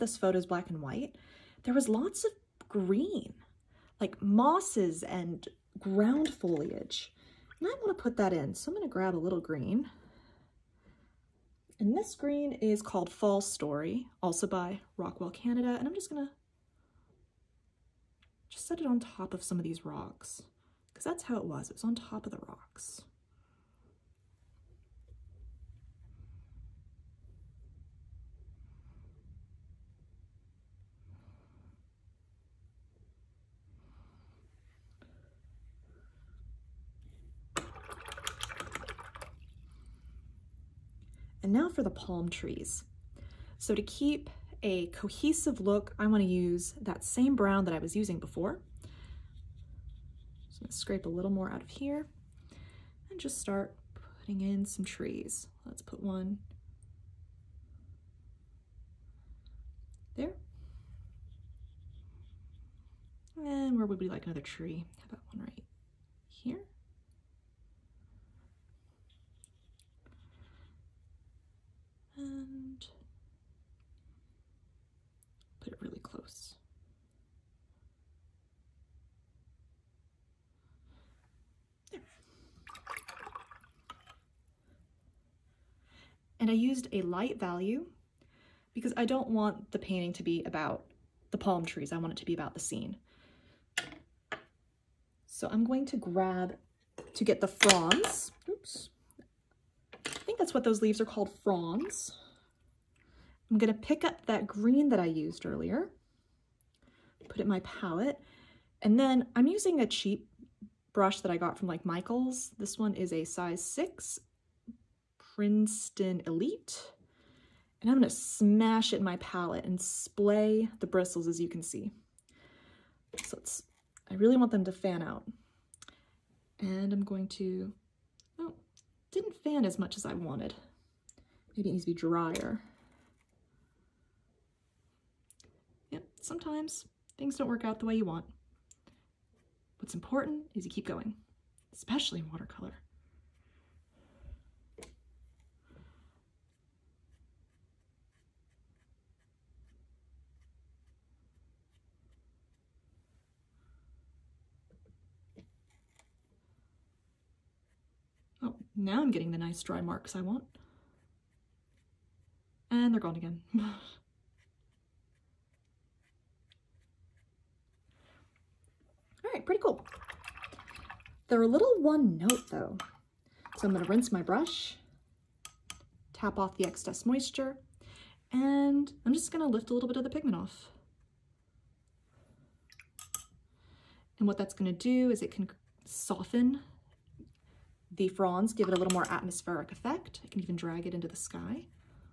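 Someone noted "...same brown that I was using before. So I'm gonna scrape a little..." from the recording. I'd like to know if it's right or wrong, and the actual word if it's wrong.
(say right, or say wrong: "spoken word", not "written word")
right.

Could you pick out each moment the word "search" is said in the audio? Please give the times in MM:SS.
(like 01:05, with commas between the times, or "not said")
not said.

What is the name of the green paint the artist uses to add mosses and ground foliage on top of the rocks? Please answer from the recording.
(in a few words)
Fall Story.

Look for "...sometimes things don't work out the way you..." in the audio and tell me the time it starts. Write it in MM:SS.
02:16.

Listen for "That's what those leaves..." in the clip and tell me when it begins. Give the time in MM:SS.
01:40.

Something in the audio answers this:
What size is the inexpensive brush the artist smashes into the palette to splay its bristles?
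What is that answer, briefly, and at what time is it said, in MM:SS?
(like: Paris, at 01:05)
6, at 01:53.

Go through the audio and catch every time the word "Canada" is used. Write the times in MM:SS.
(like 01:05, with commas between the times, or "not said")
00:15.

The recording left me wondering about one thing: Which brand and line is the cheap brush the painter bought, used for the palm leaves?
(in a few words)
Princeton Elite.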